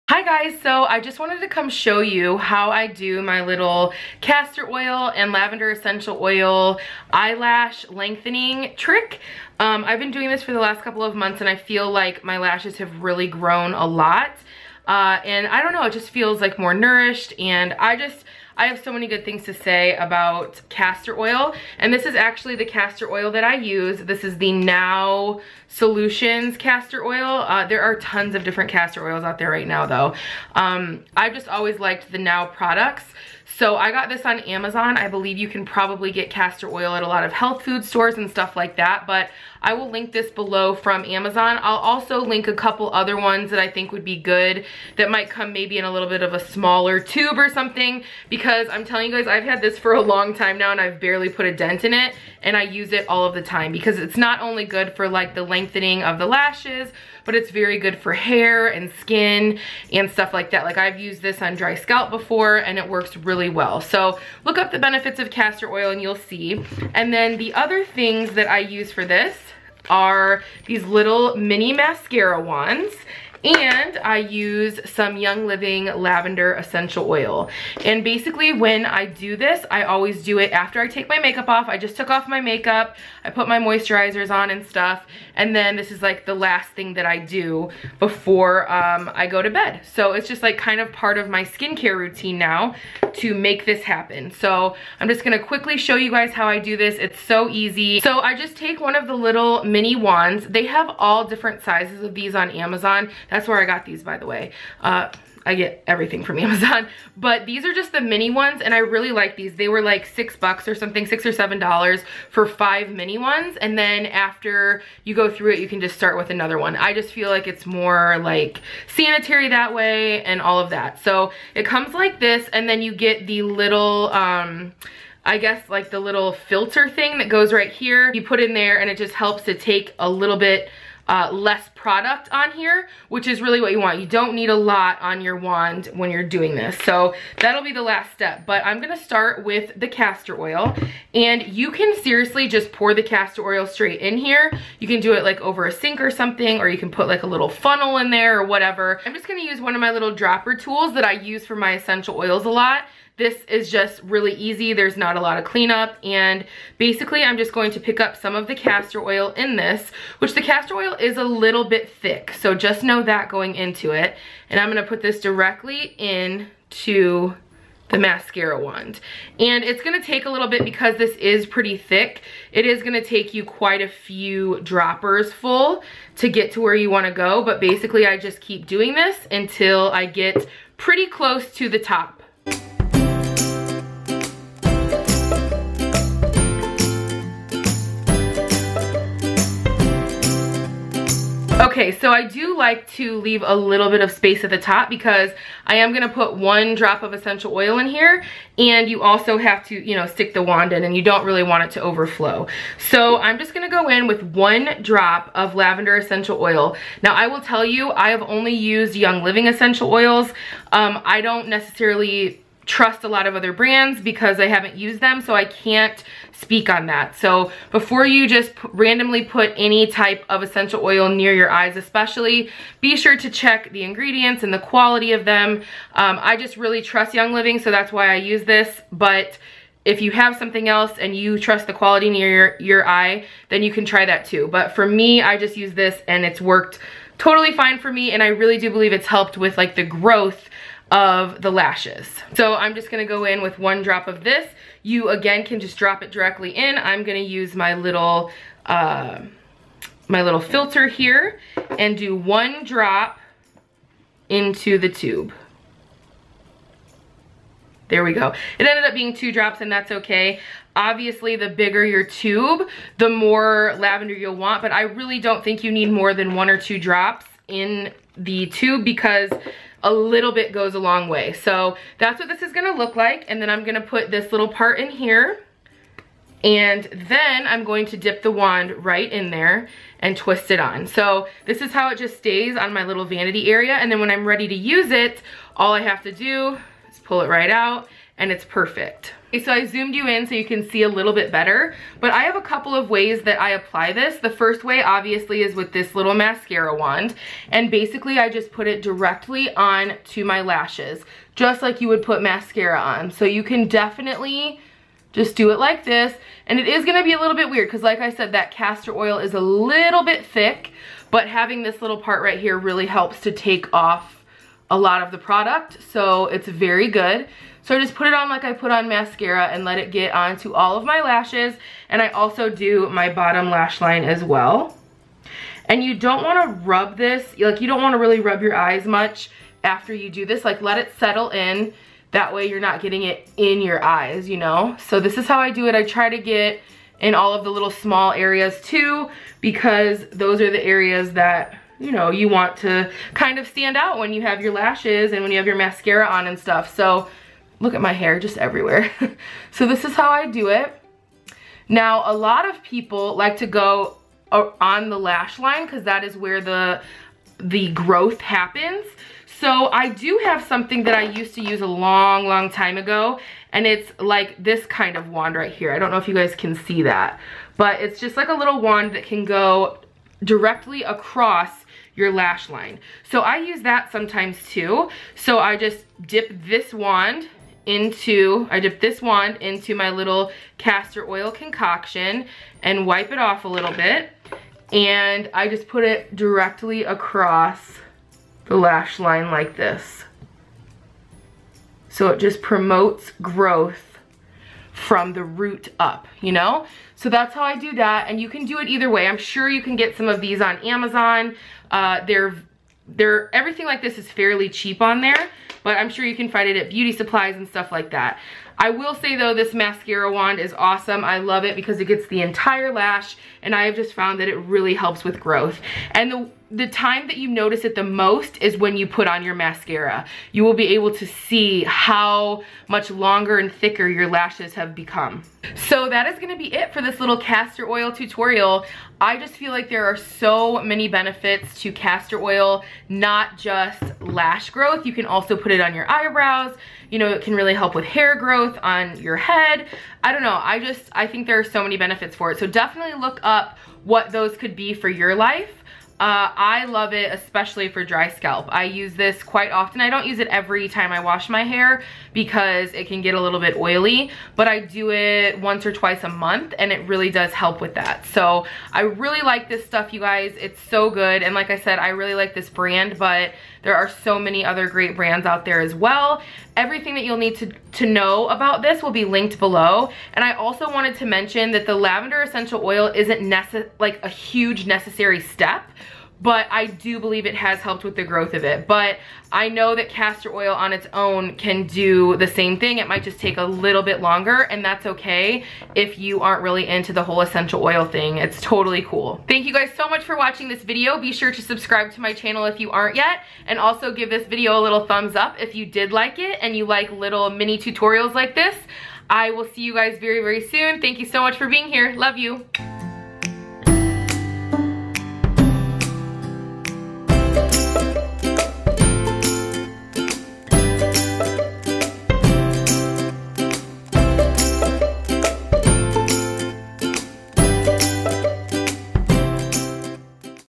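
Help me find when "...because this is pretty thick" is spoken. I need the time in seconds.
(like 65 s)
170 s.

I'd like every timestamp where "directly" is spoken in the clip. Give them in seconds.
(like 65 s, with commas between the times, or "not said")
165 s, 246 s, 298 s, 370 s, 386 s.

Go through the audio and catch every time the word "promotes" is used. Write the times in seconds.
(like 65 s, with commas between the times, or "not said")
392 s.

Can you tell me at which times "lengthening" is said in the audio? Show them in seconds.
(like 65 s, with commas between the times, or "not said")
7 s, 55 s.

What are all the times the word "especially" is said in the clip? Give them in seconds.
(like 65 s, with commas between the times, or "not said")
221 s, 447 s.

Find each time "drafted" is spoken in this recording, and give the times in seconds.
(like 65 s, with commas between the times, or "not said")
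not said.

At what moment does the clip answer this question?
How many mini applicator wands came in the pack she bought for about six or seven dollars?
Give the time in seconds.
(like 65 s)
112 s.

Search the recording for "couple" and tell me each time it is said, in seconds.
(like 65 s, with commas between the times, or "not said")
10 s, 42 s, 292 s.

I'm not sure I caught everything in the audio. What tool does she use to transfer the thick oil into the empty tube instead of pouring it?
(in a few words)
Dropper.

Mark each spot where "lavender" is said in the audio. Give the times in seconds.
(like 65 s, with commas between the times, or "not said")
5 s, 75 s, 205 s, 263 s, 471 s.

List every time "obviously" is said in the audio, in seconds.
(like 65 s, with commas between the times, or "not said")
260 s, 294 s.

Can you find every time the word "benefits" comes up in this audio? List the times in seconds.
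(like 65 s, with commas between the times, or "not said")
64 s, 430 s, 441 s.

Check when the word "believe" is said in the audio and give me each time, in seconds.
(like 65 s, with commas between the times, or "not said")
35 s, 238 s, 476 s.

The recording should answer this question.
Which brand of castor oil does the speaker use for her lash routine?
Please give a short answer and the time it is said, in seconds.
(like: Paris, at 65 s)
Now Solutions, at 24 s.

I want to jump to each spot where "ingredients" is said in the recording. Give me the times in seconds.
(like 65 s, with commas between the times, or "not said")
223 s.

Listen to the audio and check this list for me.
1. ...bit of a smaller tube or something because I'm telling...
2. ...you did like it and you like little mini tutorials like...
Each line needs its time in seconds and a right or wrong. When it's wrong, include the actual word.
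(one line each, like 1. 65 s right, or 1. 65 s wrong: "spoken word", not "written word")
1. 46 s right
2. 495 s right.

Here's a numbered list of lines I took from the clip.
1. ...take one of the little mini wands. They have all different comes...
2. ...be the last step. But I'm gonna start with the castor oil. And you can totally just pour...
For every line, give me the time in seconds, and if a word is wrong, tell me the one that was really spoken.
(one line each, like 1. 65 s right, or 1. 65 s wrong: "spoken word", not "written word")
1. 98 s wrong: "sizes", not "comes"
2. 137 s wrong: "seriously", not "totally".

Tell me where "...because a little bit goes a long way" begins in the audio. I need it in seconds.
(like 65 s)
268 s.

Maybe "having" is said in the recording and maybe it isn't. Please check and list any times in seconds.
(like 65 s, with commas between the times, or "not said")
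311 s.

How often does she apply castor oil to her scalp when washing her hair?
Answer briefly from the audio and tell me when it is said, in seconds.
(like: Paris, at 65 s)
Once or twice a month, at 455 s.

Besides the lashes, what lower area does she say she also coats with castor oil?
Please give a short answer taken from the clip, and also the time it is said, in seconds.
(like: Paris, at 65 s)
Bottom lash line, at 323 s.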